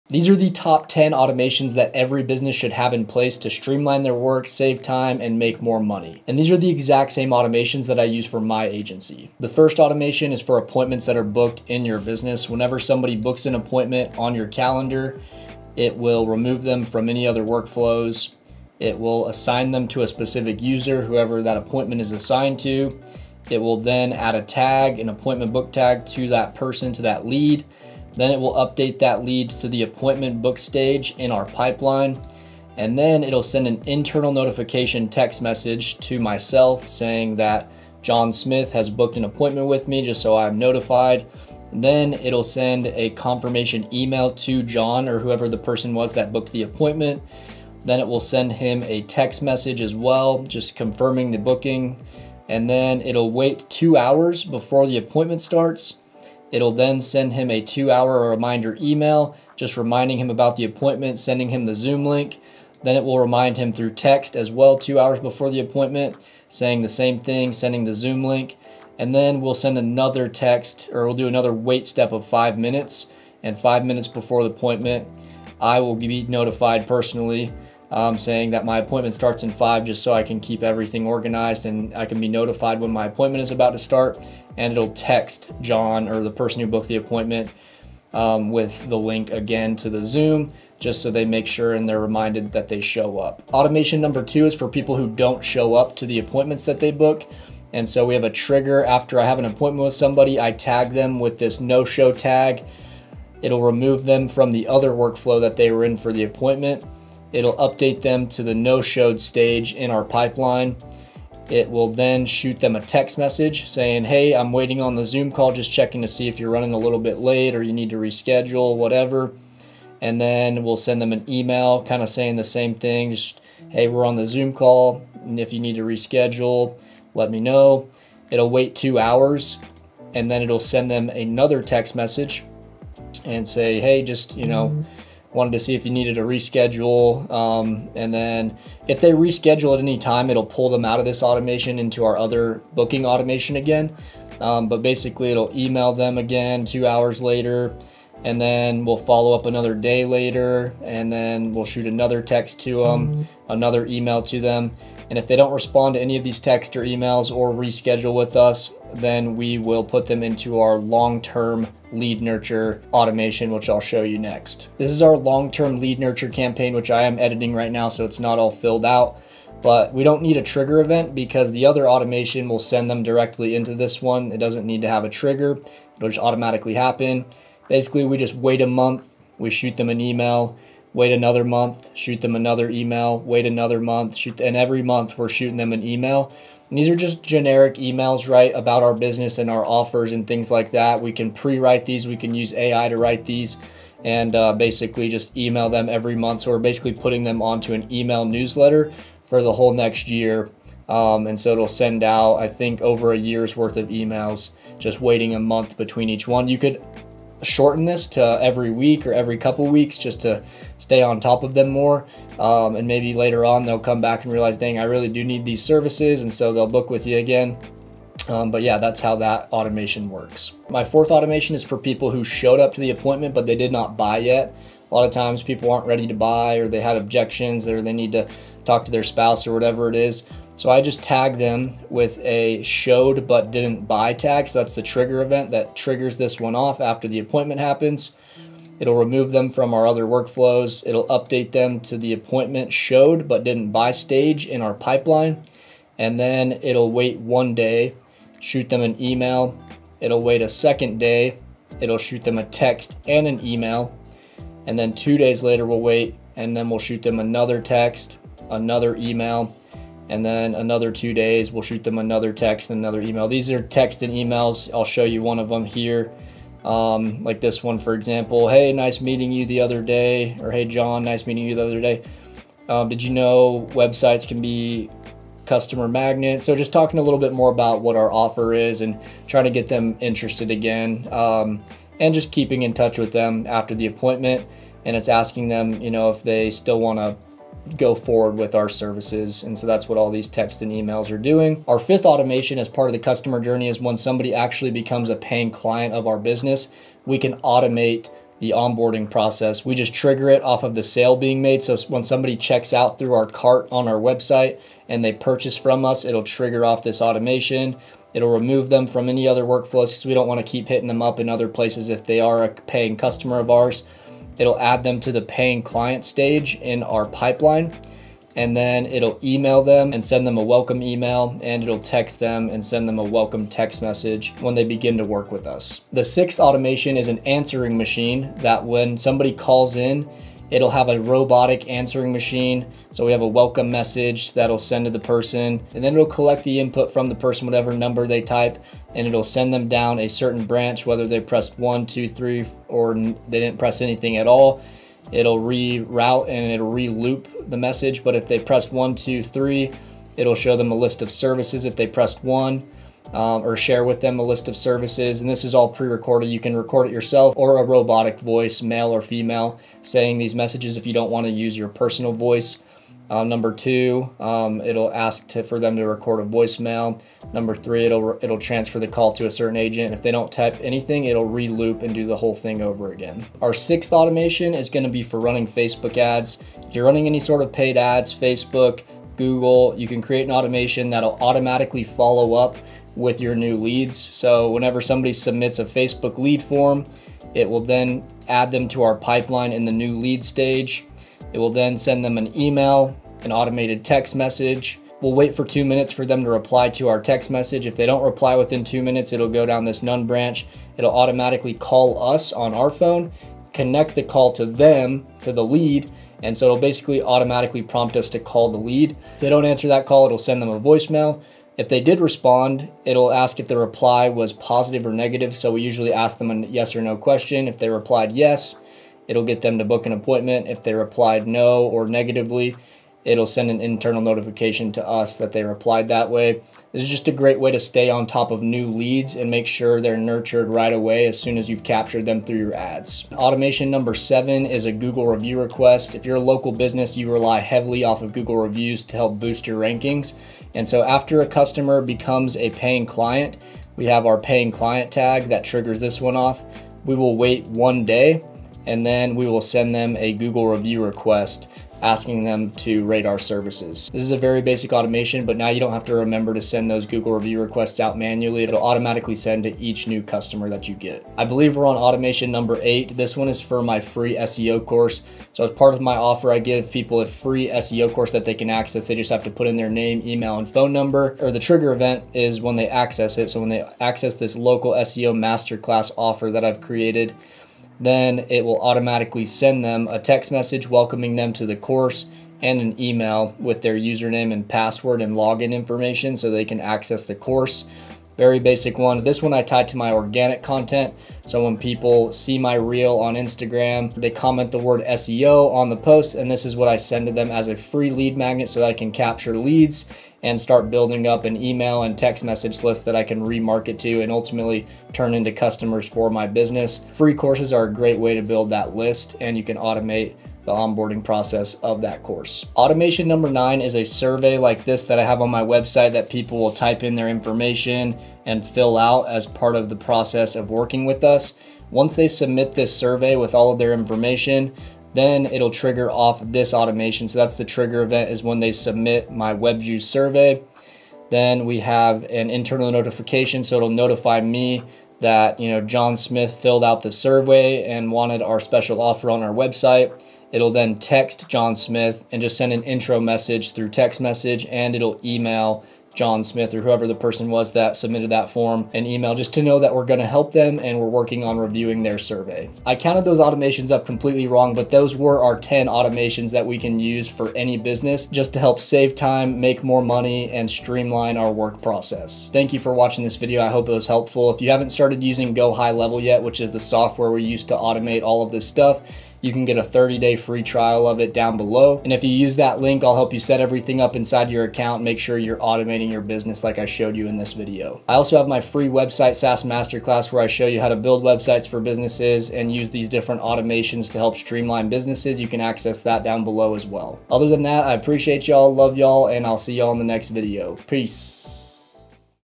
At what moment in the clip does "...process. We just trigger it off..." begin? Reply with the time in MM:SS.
04:59.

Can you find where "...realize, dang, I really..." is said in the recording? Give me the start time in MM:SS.
03:34.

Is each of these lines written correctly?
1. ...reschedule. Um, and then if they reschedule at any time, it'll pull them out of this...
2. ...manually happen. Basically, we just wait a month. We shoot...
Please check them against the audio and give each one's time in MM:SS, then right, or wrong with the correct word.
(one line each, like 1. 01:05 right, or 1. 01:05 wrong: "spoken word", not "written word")
1. 02:16 right
2. 02:56 wrong: "automatically", not "manually".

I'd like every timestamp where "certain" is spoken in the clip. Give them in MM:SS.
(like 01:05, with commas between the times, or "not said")
05:40, 06:09.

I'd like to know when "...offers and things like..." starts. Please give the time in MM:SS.
03:09.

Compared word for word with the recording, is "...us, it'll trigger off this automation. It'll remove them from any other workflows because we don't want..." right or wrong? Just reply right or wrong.
right.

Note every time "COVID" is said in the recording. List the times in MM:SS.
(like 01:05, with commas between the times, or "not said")
not said.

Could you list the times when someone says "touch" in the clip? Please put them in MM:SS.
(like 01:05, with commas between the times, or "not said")
04:42.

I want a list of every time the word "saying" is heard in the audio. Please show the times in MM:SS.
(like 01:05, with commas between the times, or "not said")
00:36, 01:06, 01:18, 01:53, 02:02, 05:59.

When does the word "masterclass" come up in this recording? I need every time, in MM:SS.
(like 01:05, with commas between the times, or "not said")
07:55, 09:39.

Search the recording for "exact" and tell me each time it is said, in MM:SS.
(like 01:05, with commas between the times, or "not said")
00:06.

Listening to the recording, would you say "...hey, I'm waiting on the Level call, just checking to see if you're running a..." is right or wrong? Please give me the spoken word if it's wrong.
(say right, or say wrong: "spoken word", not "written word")
wrong: "Zoom", not "Level".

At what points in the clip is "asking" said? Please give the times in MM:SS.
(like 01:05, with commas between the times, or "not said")
04:45, 07:31.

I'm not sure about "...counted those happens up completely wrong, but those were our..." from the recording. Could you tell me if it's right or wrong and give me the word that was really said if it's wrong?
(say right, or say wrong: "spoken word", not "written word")
wrong: "automations", not "happens".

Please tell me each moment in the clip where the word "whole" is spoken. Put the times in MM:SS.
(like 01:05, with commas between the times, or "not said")
03:19, 06:12.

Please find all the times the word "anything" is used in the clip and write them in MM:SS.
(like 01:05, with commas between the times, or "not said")
05:43, 06:10.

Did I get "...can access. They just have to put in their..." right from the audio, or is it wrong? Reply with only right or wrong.
right.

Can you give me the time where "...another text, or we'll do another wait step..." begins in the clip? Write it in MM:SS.
01:09.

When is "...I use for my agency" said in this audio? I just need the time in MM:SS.
00:07.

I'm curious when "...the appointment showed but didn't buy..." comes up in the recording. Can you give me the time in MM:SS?
04:01.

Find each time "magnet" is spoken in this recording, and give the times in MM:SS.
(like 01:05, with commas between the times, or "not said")
04:35, 08:18.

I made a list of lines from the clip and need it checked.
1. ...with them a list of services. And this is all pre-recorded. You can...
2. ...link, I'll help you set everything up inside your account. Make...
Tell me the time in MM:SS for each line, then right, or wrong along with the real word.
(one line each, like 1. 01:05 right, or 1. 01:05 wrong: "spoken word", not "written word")
1. 05:53 right
2. 09:32 right.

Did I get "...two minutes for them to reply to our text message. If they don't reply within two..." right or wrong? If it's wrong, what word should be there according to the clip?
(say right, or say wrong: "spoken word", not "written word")
right.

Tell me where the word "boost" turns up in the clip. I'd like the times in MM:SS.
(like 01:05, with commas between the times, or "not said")
07:19.